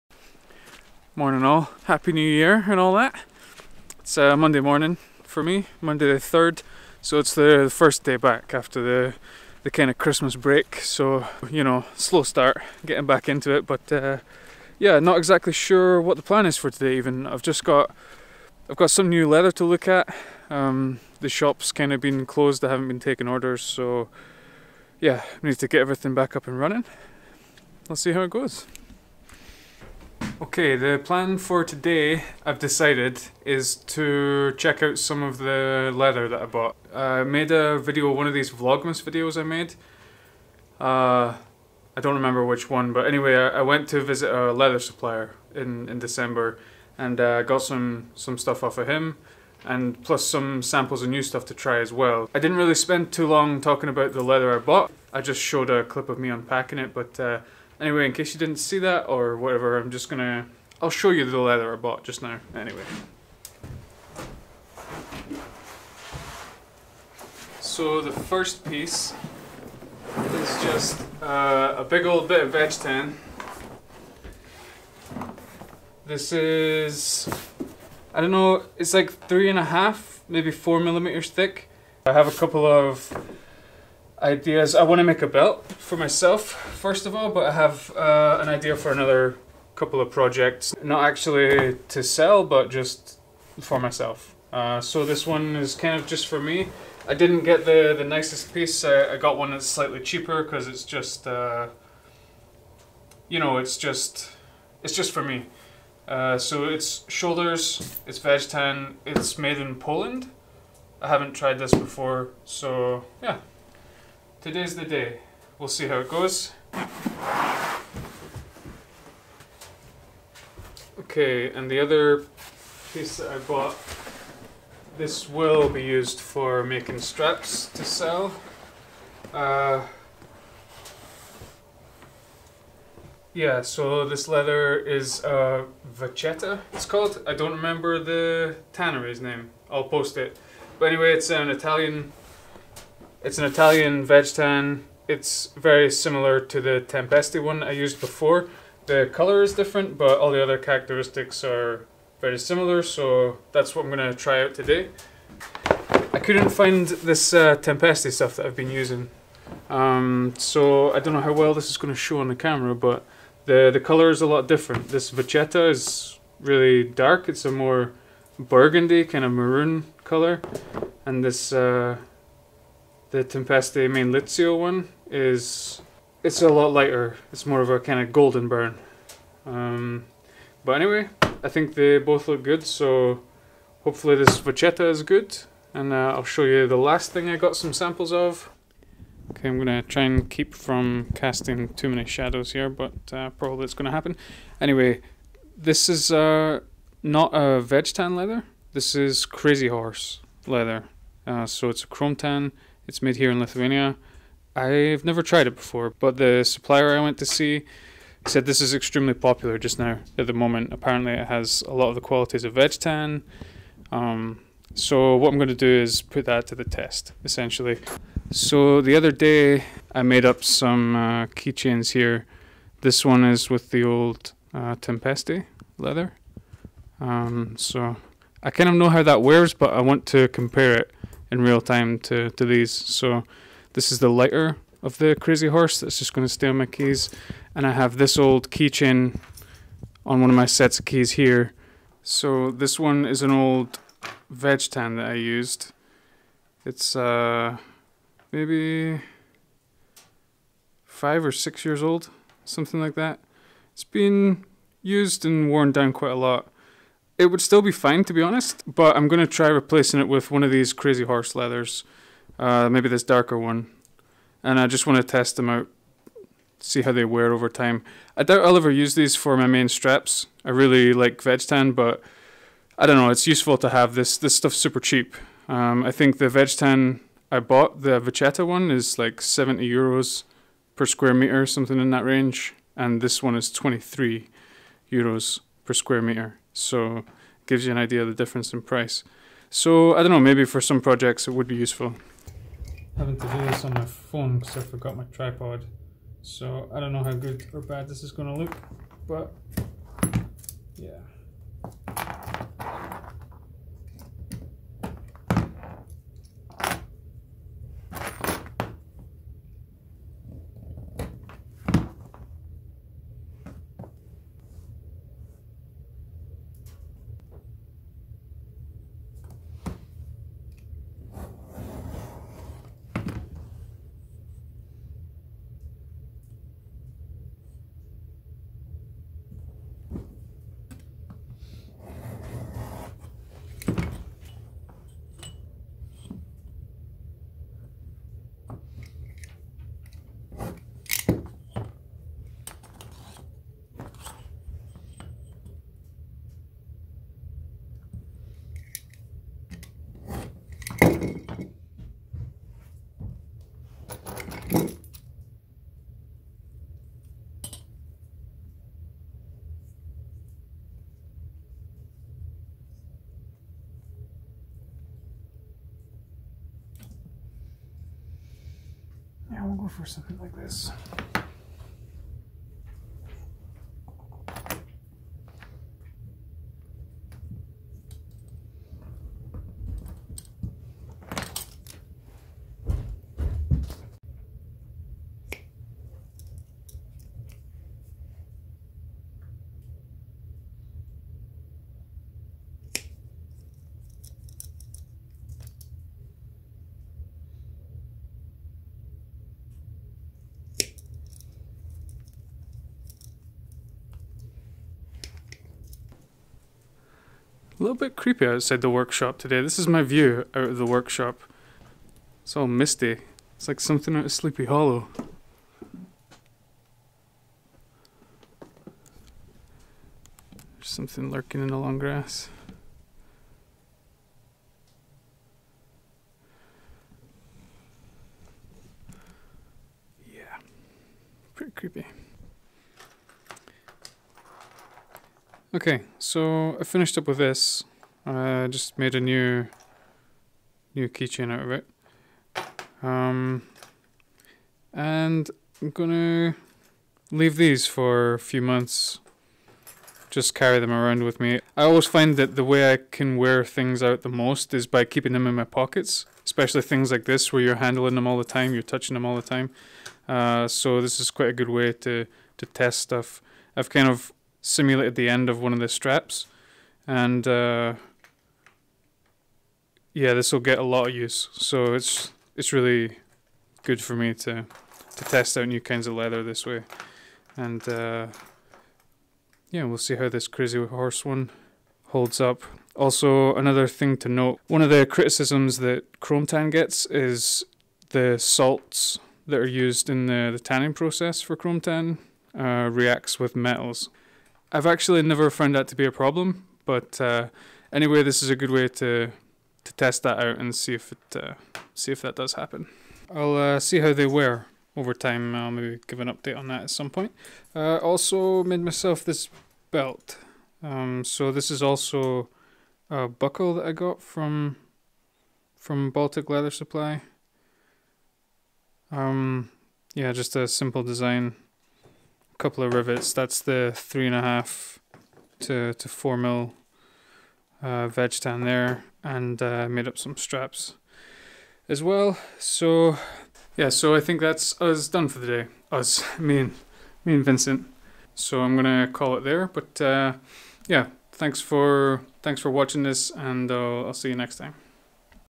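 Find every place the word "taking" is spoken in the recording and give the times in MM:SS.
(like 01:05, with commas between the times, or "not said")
00:23.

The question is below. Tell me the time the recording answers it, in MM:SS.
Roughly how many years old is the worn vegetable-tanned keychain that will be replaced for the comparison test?
04:10.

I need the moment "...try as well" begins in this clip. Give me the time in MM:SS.
00:51.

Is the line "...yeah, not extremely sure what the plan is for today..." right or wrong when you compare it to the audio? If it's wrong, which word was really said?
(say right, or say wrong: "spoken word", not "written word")
wrong: "exactly", not "extremely".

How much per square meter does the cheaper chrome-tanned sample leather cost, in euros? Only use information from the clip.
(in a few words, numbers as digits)
23 euros.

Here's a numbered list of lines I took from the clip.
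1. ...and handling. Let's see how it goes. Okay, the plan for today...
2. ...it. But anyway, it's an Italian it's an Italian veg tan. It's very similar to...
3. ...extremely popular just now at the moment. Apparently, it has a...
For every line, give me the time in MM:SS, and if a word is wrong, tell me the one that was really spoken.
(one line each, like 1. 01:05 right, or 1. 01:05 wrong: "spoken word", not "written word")
1. 00:26 wrong: "running", not "handling"
2. 02:20 right
3. 03:28 right.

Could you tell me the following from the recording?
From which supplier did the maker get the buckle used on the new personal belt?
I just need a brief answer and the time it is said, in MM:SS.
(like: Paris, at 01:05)
Baltic Leather Supply, at 08:35.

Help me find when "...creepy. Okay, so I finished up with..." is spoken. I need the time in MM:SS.
07:11.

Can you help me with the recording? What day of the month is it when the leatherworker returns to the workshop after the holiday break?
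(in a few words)
3rd.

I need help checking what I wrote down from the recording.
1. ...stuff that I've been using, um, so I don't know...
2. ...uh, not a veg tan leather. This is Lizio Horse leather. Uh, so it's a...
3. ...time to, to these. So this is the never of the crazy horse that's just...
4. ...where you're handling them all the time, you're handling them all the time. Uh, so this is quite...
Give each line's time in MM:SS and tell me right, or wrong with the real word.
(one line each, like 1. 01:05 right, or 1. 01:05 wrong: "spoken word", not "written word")
1. 02:38 right
2. 03:16 wrong: "Crazy", not "Lizio"
3. 03:51 wrong: "lighter", not "never"
4. 07:37 wrong: "touching", not "handling".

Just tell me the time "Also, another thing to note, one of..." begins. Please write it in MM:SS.
08:02.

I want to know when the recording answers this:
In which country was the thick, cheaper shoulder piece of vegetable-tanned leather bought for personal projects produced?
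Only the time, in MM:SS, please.
01:49.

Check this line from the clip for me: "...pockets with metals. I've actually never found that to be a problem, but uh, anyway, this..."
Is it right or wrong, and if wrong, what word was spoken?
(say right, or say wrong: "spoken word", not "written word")
wrong: "reacts", not "pockets".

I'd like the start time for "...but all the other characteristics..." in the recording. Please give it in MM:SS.
02:29.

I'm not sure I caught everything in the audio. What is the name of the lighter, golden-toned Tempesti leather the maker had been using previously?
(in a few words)
Lizio.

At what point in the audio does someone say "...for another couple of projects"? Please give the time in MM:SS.
01:28.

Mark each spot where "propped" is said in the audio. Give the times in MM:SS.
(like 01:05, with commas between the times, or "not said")
not said.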